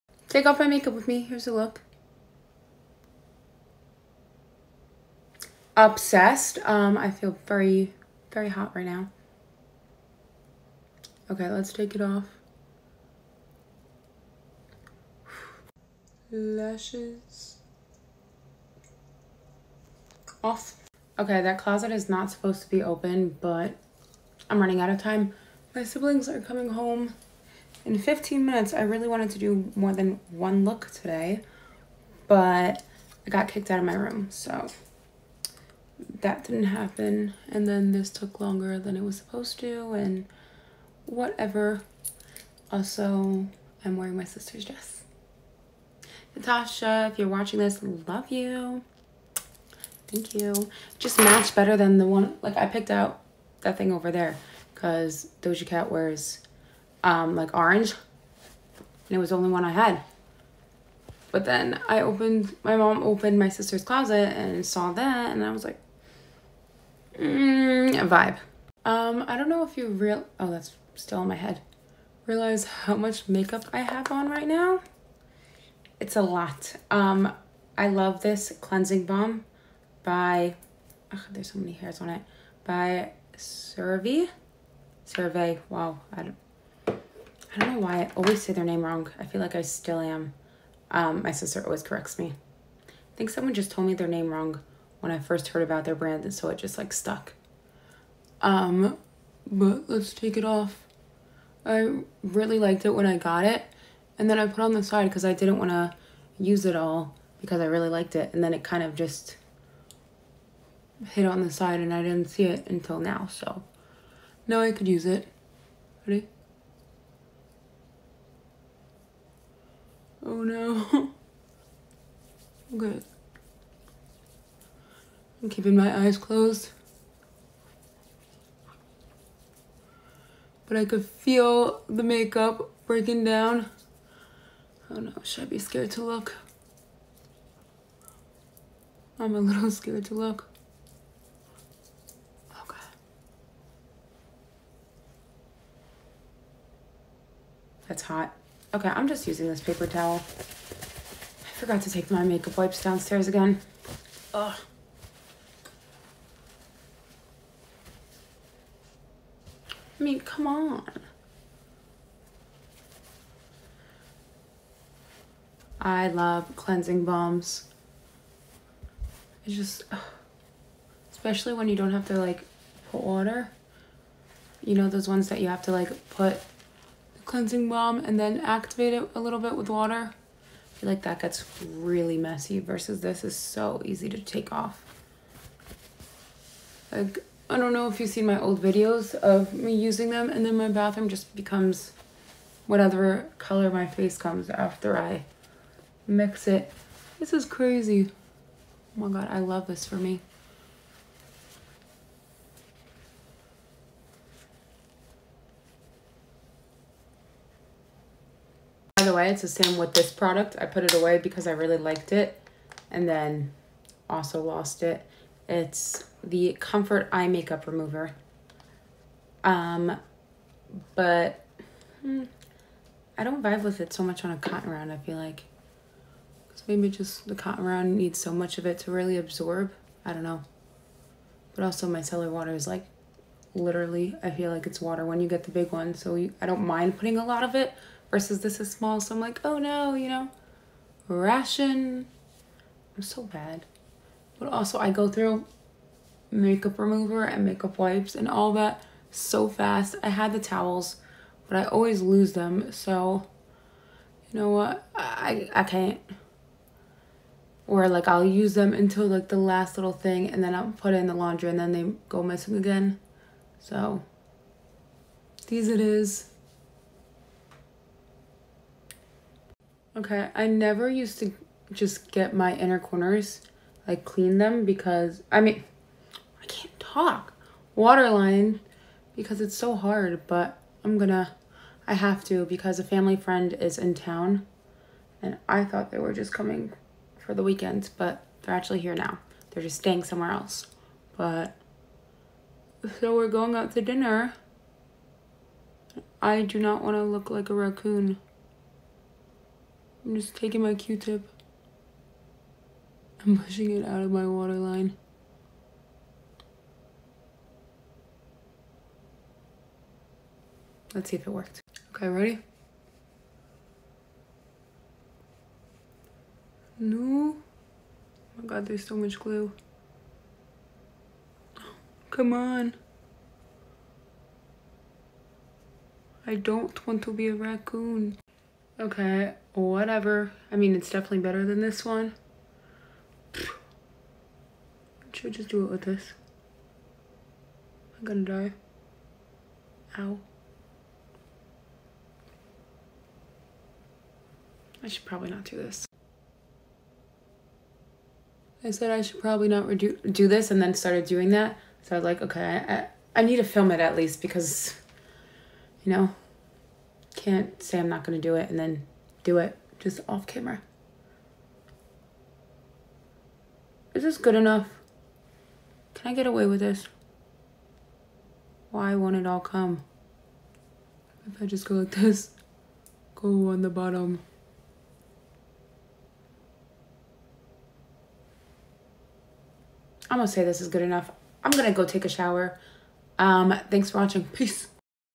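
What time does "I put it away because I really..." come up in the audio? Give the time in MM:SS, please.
03:30.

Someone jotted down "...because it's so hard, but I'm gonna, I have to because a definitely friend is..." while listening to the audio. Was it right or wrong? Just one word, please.
wrong.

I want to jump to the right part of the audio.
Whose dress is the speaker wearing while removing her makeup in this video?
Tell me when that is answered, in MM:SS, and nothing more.
00:46.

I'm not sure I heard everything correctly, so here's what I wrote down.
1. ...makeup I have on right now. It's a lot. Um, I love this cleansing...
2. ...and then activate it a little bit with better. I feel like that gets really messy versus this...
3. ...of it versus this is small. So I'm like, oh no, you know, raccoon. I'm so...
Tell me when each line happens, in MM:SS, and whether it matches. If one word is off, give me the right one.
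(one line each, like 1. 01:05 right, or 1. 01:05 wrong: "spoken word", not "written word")
1. 01:13 right
2. 02:57 wrong: "water", not "better"
3. 03:57 wrong: "ration", not "raccoon".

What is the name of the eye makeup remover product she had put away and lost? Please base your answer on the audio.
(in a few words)
Comfort Eye Makeup Remover.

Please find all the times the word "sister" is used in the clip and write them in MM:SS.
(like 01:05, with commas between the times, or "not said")
00:44, 01:03, 01:31.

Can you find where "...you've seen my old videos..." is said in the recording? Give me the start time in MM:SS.
03:08.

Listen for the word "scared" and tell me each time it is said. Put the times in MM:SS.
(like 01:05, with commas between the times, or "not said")
02:15, 02:19.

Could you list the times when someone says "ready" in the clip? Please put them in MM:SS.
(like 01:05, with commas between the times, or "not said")
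01:56, 05:12.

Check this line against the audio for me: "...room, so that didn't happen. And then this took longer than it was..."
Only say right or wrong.
right.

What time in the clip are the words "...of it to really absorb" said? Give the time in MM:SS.
03:48.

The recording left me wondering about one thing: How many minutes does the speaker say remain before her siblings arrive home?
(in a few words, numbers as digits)
15.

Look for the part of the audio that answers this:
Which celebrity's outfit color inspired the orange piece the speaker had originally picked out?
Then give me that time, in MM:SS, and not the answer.
00:55.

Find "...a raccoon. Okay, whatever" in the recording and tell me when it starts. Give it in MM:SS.
05:27.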